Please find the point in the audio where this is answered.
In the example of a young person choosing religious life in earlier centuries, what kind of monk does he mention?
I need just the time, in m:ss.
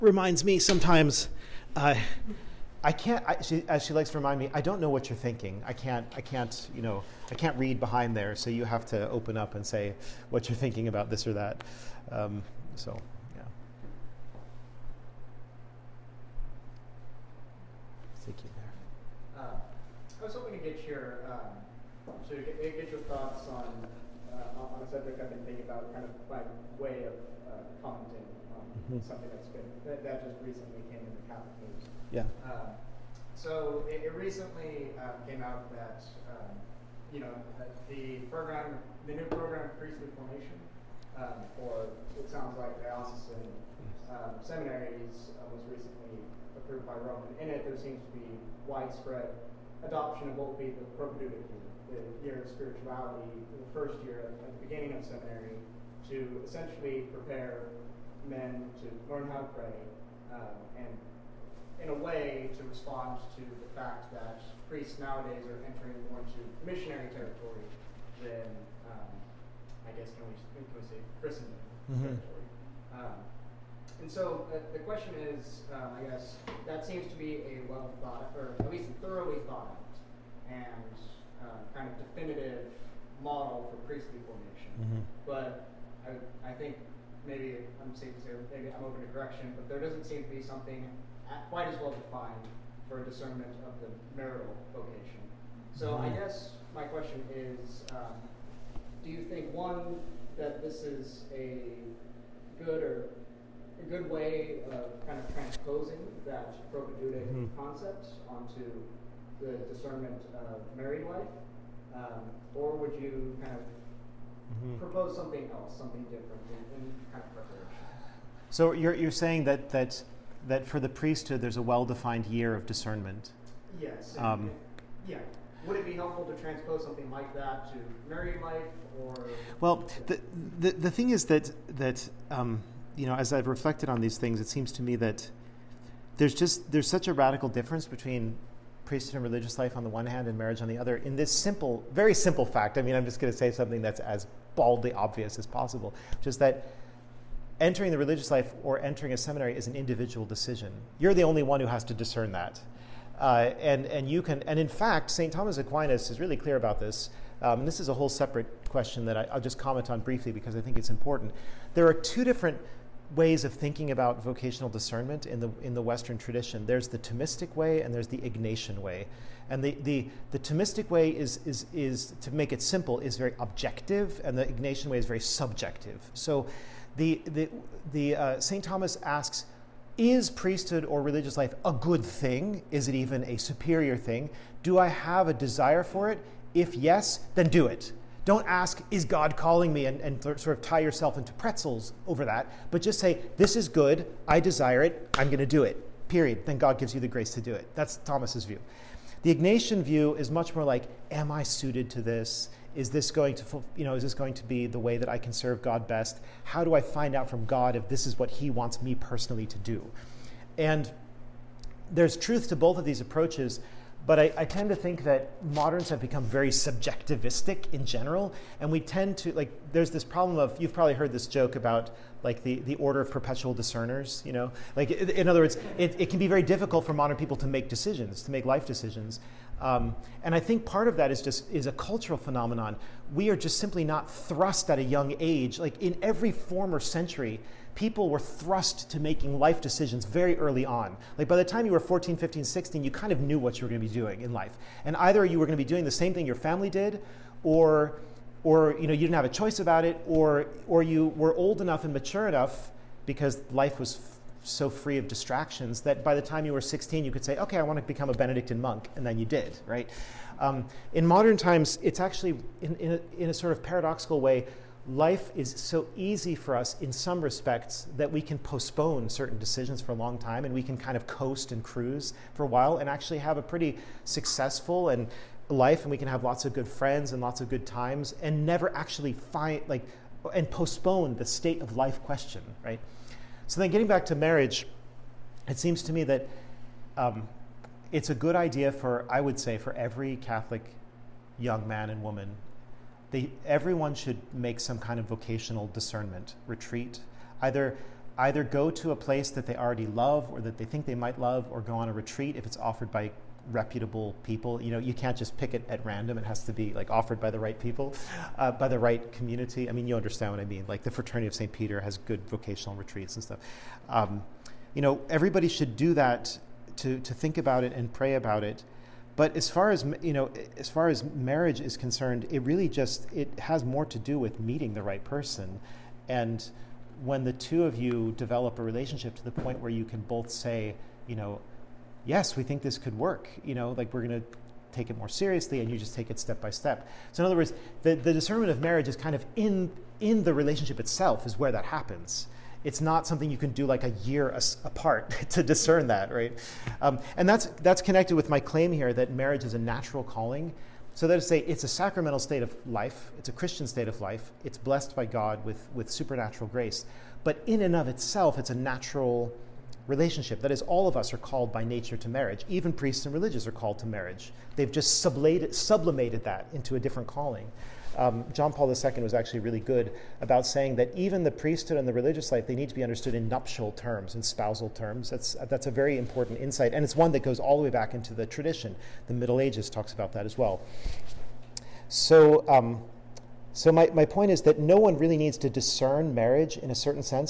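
4:18.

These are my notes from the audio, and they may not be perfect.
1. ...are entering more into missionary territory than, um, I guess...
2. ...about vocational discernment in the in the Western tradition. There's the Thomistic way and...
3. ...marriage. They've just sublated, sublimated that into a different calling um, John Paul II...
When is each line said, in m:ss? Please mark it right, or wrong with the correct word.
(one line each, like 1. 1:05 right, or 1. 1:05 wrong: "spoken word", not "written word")
1. 1:05 right
2. 2:43 right
3. 6:03 right.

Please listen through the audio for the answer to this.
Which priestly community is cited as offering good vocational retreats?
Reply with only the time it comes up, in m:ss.
5:10.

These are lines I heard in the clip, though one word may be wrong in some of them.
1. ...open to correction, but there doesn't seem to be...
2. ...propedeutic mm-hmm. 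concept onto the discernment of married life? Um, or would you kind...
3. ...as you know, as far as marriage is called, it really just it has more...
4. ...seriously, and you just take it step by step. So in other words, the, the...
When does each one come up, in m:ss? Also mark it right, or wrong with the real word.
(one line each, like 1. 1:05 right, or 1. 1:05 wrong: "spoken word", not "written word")
1. 1:28 right
2. 1:46 right
3. 5:19 wrong: "concerned", not "called"
4. 5:35 right.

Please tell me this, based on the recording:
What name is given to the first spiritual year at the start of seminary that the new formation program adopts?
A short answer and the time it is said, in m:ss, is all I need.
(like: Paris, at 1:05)
propedeutic year, at 0:50.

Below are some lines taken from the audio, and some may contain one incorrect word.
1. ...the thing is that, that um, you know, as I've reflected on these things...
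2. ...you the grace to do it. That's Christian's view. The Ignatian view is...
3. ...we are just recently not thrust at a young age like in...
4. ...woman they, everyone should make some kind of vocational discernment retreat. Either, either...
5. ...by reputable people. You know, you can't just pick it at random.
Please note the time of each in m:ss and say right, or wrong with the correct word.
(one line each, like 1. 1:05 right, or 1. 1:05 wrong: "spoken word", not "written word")
1. 2:10 right
2. 3:16 wrong: "Thomas", not "Christian"
3. 3:53 wrong: "simply", not "recently"
4. 4:52 right
5. 5:02 right.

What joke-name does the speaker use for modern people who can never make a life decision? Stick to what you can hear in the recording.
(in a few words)
order of perpetual discerners.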